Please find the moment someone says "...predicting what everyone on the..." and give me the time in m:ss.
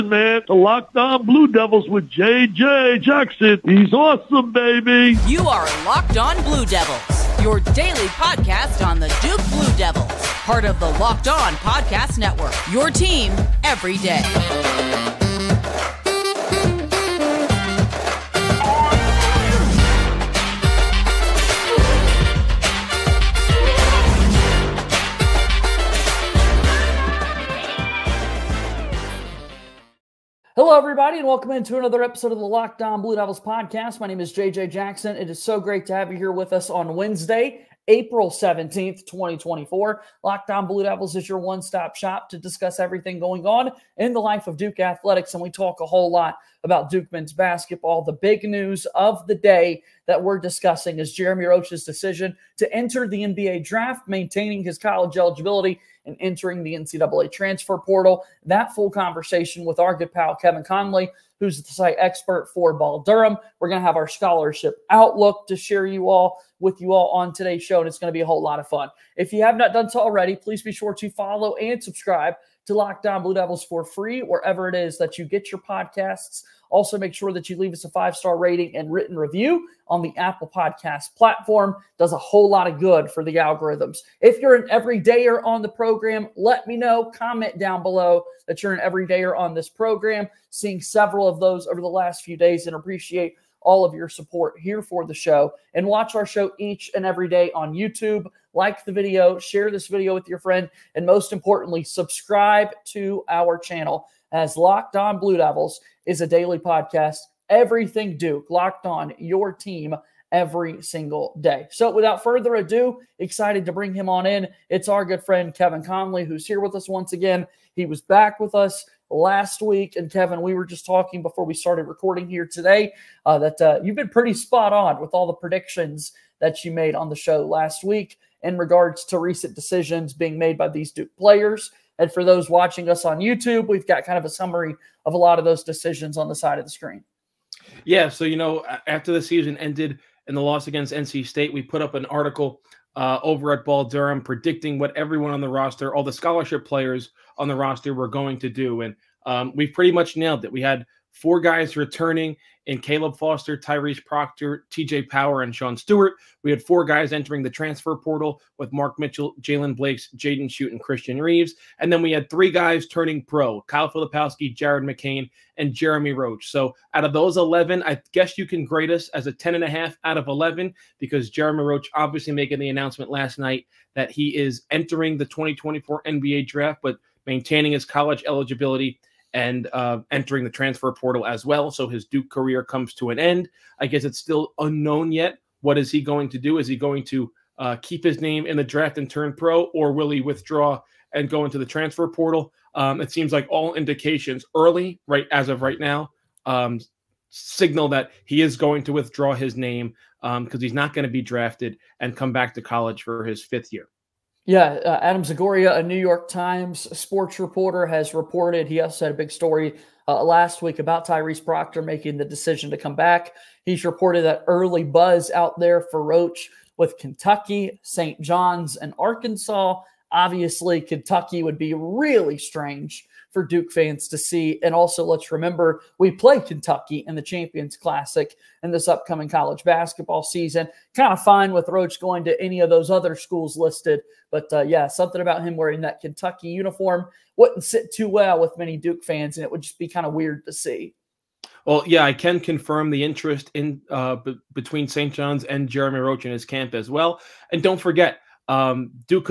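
2:24.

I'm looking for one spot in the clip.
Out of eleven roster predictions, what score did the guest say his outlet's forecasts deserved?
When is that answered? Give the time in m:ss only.
2:49.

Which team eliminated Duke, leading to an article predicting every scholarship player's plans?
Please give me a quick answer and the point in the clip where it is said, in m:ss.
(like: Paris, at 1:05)
NC State, at 2:20.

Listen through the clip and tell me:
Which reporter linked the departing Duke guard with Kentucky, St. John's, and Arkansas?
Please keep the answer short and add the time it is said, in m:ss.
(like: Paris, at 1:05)
Adam Zagoria, at 3:25.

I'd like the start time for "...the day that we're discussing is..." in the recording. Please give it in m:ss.
0:49.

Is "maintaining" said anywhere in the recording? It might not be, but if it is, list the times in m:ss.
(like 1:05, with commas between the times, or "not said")
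0:54, 2:57.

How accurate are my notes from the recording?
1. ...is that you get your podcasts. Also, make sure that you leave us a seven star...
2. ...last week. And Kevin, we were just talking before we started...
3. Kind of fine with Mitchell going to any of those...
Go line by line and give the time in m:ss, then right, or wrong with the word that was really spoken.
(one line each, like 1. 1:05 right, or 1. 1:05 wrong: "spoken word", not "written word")
1. 1:14 wrong: "five", not "seven"
2. 1:59 right
3. 3:50 wrong: "Roach", not "Mitchell".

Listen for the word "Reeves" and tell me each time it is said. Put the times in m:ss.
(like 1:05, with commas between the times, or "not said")
2:41.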